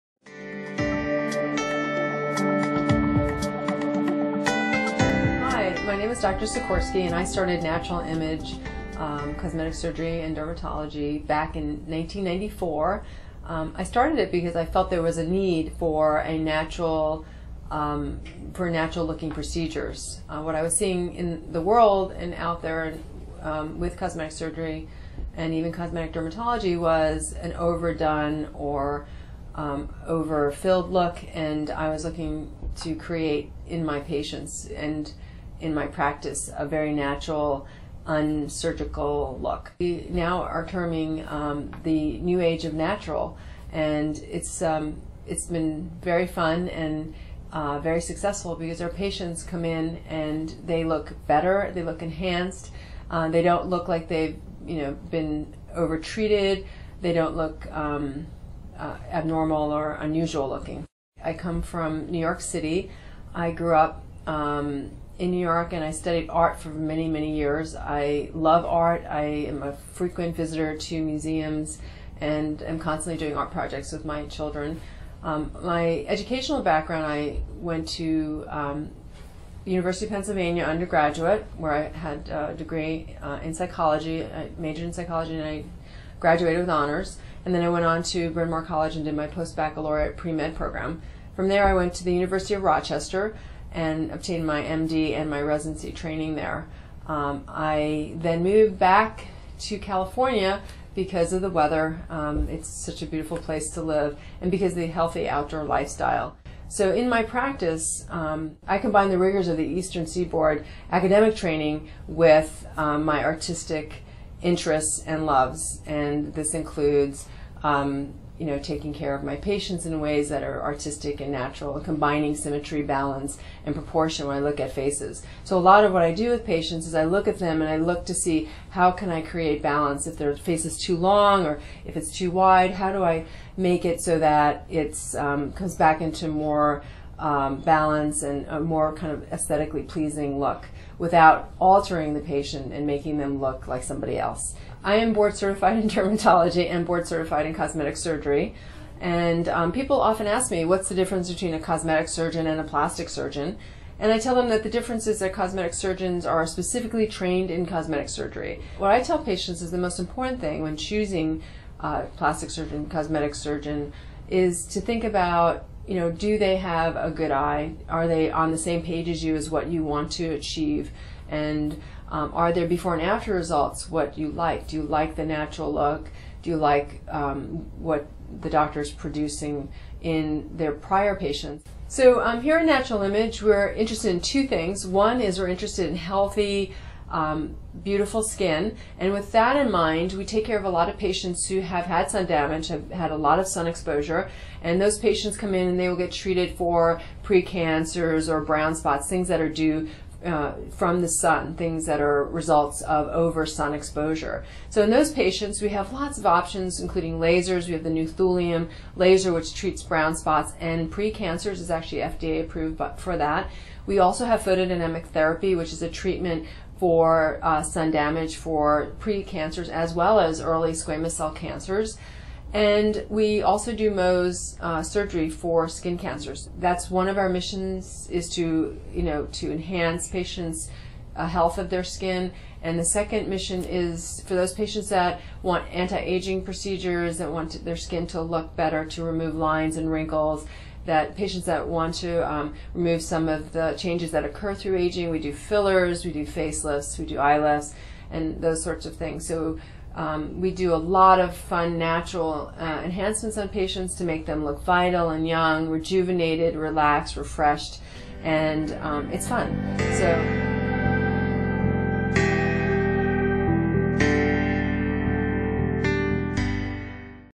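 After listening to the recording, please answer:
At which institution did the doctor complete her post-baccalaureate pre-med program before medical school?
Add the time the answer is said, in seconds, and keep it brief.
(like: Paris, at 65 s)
Bryn Mawr College, at 88 s.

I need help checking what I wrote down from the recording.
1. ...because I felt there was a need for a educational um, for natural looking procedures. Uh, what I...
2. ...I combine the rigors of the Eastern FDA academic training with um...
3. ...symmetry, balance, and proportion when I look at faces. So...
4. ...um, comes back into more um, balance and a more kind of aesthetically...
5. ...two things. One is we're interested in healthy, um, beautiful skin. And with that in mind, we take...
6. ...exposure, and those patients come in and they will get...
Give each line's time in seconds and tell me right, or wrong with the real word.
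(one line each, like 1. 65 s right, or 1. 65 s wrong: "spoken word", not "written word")
1. 14 s wrong: "natural", not "educational"
2. 108 s wrong: "Seaboard", not "FDA"
3. 122 s right
4. 135 s right
5. 184 s right
6. 193 s right.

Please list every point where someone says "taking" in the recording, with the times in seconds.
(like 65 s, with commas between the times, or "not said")
118 s.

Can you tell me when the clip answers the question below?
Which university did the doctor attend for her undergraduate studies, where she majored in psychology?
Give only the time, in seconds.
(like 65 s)
79 s.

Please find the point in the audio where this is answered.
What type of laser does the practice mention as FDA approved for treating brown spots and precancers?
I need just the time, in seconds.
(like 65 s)
208 s.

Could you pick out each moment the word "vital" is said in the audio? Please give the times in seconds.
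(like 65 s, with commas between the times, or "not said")
254 s.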